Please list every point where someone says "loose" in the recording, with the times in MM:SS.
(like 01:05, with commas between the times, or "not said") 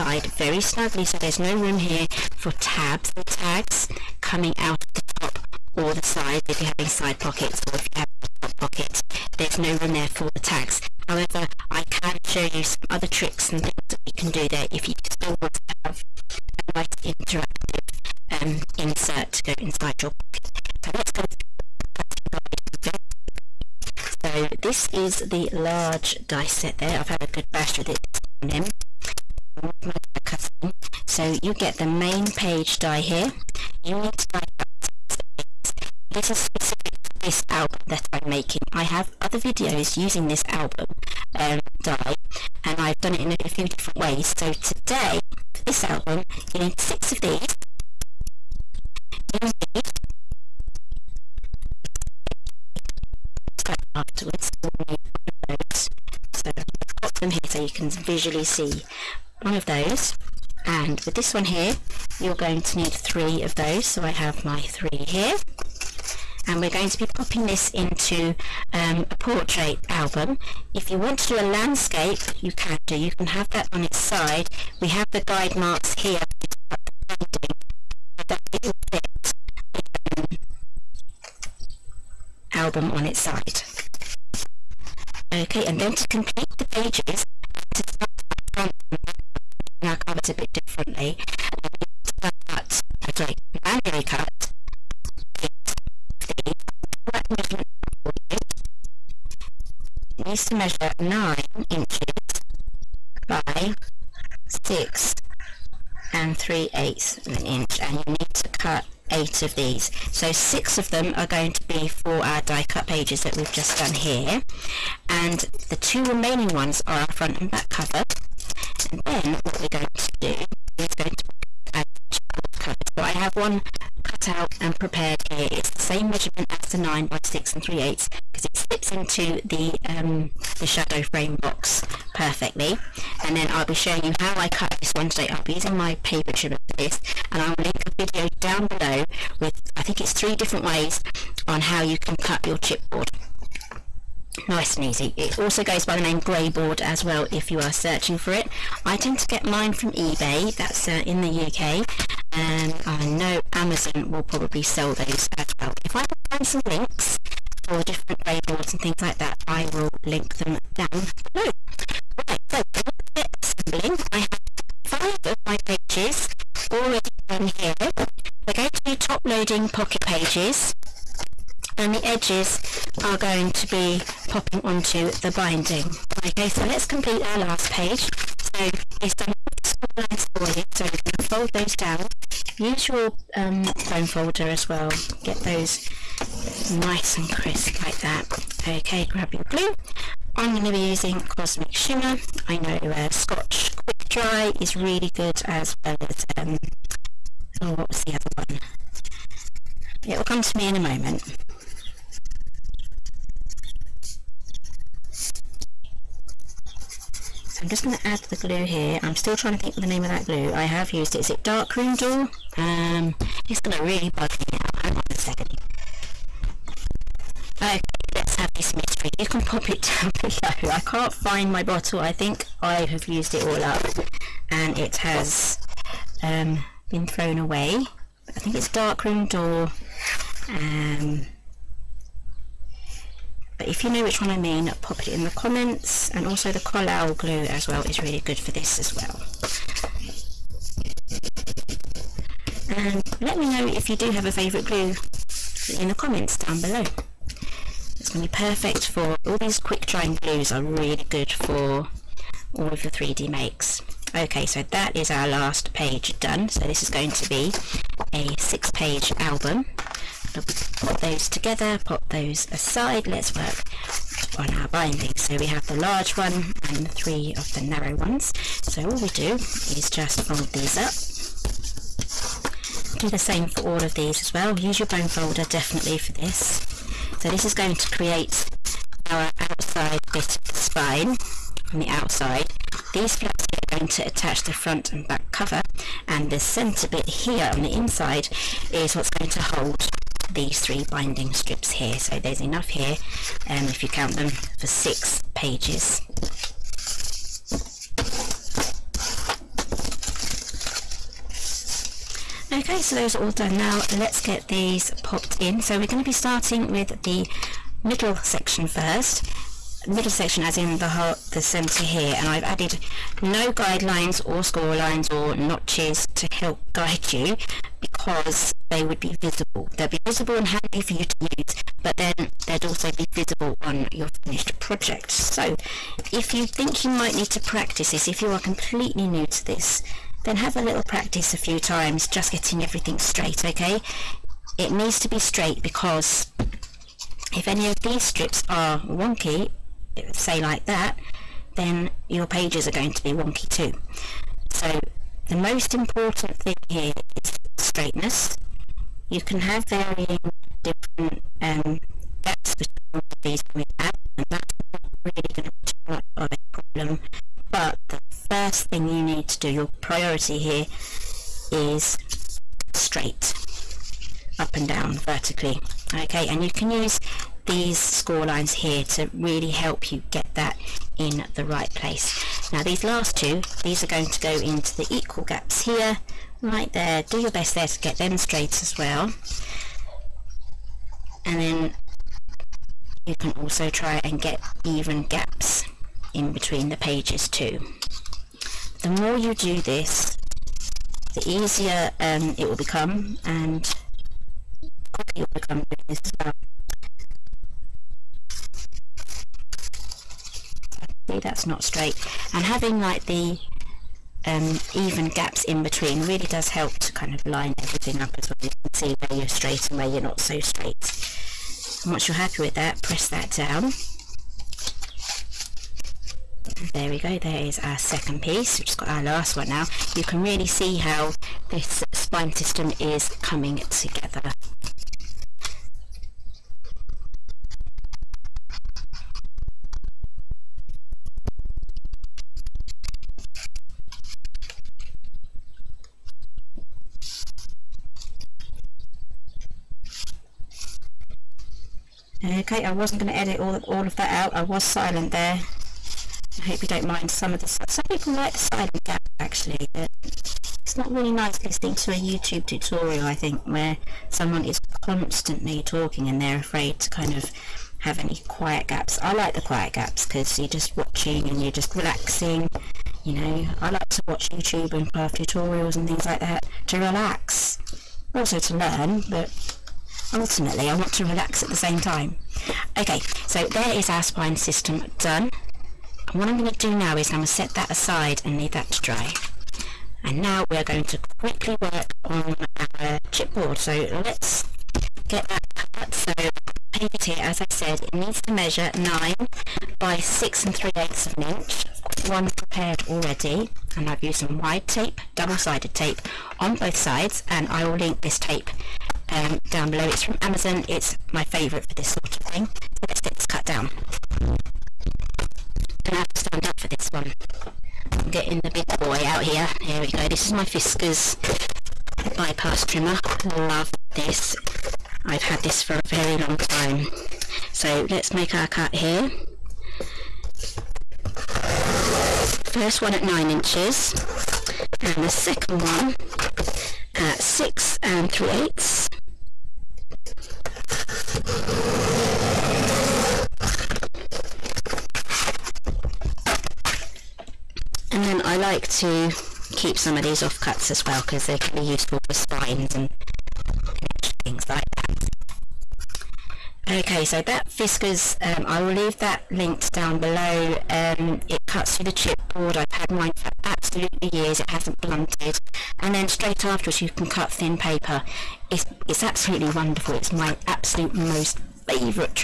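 not said.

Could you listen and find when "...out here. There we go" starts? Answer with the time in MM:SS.
08:29.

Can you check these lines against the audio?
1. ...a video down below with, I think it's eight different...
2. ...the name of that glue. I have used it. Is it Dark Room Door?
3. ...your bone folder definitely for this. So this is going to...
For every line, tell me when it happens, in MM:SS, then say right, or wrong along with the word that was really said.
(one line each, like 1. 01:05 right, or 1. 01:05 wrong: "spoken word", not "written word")
1. 02:17 wrong: "three", not "eight"
2. 03:29 right
3. 04:34 right.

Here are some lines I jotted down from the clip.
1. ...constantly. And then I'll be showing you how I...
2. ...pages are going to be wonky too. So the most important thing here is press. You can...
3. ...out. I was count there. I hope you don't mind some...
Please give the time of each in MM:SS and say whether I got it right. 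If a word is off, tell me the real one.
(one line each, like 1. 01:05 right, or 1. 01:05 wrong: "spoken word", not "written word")
1. 02:12 wrong: "perfectly", not "constantly"
2. 05:42 wrong: "straightness", not "press"
3. 07:24 wrong: "silent", not "count".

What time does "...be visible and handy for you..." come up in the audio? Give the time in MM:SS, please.
05:19.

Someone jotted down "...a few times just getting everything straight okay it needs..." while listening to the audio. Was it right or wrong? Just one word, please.
right.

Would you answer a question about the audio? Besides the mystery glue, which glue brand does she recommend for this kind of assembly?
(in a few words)
Collall.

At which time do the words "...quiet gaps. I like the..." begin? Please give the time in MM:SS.
07:38.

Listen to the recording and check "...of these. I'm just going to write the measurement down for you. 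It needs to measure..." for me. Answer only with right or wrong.
right.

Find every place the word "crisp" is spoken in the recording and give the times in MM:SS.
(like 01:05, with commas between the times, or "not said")
03:07.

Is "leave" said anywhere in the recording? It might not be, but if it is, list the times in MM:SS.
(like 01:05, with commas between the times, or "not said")
07:58, 09:08.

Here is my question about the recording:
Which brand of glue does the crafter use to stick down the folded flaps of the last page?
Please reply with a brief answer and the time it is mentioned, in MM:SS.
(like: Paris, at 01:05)
Cosmic Shimmer, at 03:11.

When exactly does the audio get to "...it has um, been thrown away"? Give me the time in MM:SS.
03:44.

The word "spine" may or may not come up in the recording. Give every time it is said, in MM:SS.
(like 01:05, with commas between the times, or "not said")
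04:40, 07:01, 07:54, 09:02.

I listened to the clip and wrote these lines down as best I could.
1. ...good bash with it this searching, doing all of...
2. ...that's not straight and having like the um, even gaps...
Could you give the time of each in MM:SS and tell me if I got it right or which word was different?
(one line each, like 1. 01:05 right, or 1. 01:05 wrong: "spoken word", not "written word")
1. 00:27 wrong: "morning", not "searching"
2. 06:41 right.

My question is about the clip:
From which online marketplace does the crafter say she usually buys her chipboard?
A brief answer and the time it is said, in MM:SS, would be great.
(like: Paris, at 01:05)
eBay, at 02:29.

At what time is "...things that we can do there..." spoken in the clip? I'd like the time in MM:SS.
00:13.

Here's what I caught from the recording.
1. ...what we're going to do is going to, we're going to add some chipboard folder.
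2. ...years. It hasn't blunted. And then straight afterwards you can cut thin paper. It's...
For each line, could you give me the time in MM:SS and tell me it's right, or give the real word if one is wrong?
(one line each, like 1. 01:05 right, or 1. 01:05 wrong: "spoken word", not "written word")
1. 01:59 wrong: "cover", not "folder"
2. 09:14 right.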